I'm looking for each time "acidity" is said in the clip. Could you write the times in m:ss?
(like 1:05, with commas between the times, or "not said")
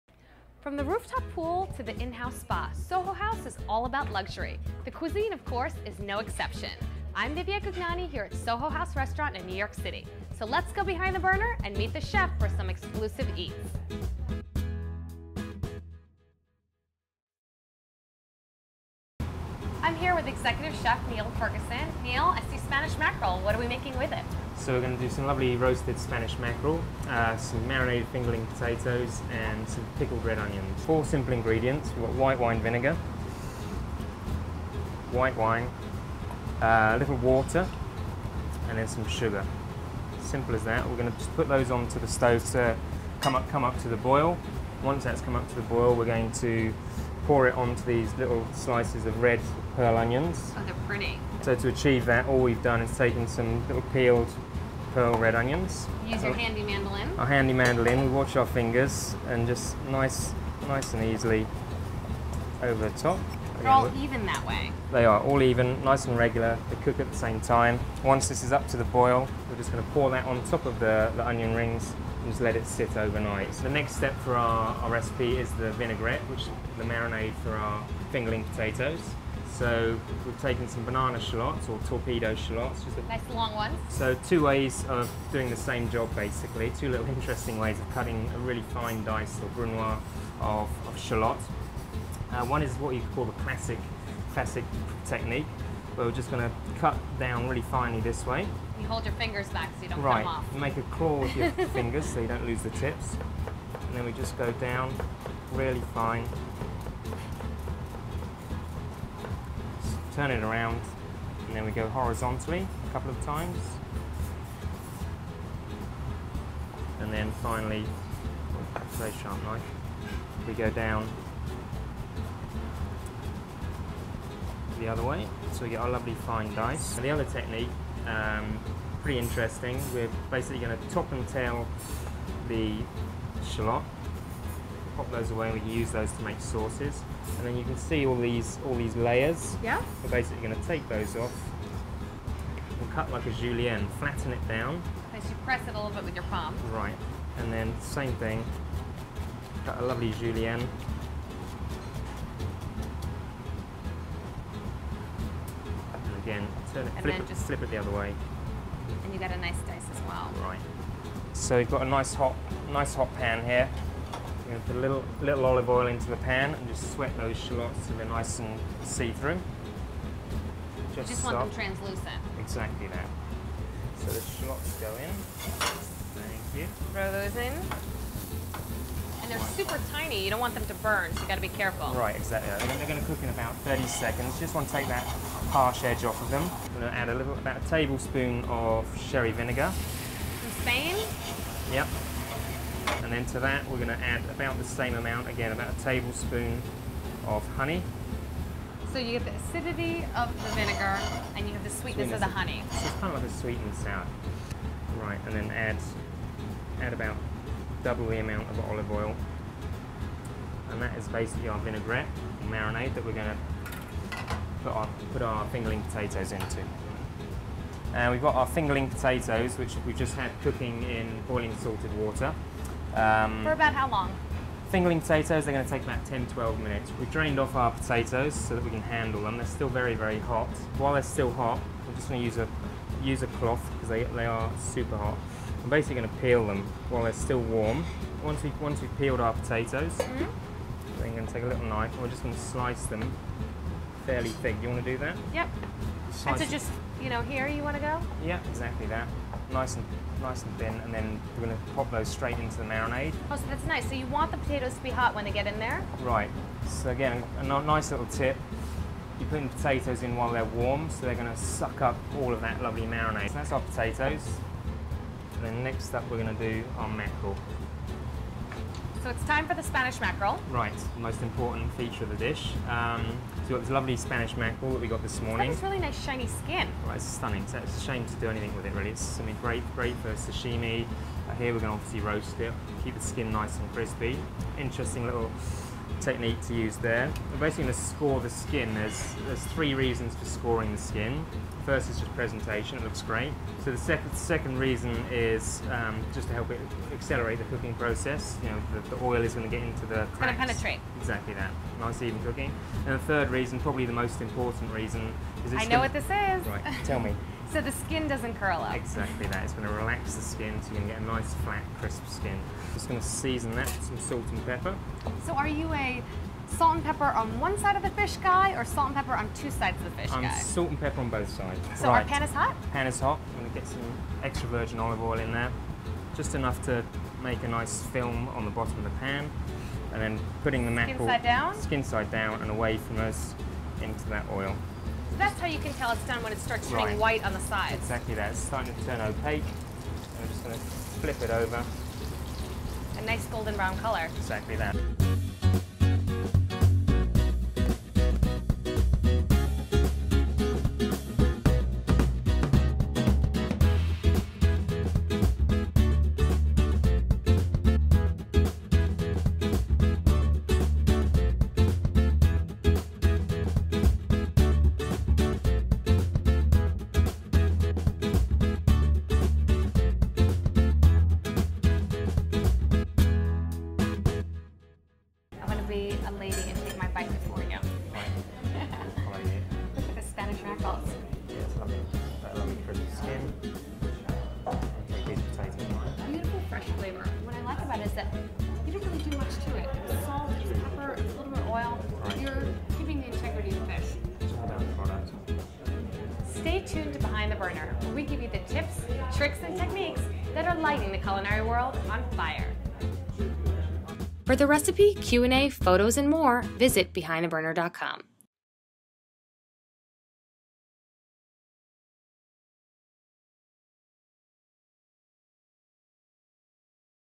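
3:19.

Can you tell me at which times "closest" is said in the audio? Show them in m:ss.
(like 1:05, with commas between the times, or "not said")
not said.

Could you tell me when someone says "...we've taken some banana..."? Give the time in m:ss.
1:20.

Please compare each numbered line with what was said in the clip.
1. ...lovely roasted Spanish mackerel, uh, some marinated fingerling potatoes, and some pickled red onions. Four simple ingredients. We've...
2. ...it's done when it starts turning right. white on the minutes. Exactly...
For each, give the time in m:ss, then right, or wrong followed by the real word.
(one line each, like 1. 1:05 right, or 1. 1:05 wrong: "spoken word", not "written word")
1. 0:25 right
2. 5:35 wrong: "sides", not "minutes".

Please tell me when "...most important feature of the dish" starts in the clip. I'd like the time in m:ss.
4:30.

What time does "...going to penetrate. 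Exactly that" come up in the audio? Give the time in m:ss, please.
5:00.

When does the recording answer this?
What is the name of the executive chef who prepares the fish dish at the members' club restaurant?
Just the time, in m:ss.
0:21.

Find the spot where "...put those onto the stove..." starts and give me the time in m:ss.
0:41.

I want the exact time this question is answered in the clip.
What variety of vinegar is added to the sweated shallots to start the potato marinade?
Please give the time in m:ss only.
3:09.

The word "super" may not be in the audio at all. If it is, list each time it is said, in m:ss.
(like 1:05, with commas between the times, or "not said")
2:59, 3:54.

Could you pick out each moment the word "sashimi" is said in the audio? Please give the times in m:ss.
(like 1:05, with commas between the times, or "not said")
4:40.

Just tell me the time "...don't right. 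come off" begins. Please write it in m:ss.
1:39.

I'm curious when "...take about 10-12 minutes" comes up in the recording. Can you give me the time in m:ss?
3:45.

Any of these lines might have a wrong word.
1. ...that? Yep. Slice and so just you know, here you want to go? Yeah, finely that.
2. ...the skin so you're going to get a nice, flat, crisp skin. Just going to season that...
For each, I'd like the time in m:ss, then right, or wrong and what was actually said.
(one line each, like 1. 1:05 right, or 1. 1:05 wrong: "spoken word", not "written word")
1. 4:04 wrong: "exactly", not "finely"
2. 5:10 right.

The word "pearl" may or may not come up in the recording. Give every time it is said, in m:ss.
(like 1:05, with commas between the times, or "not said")
0:49, 0:54.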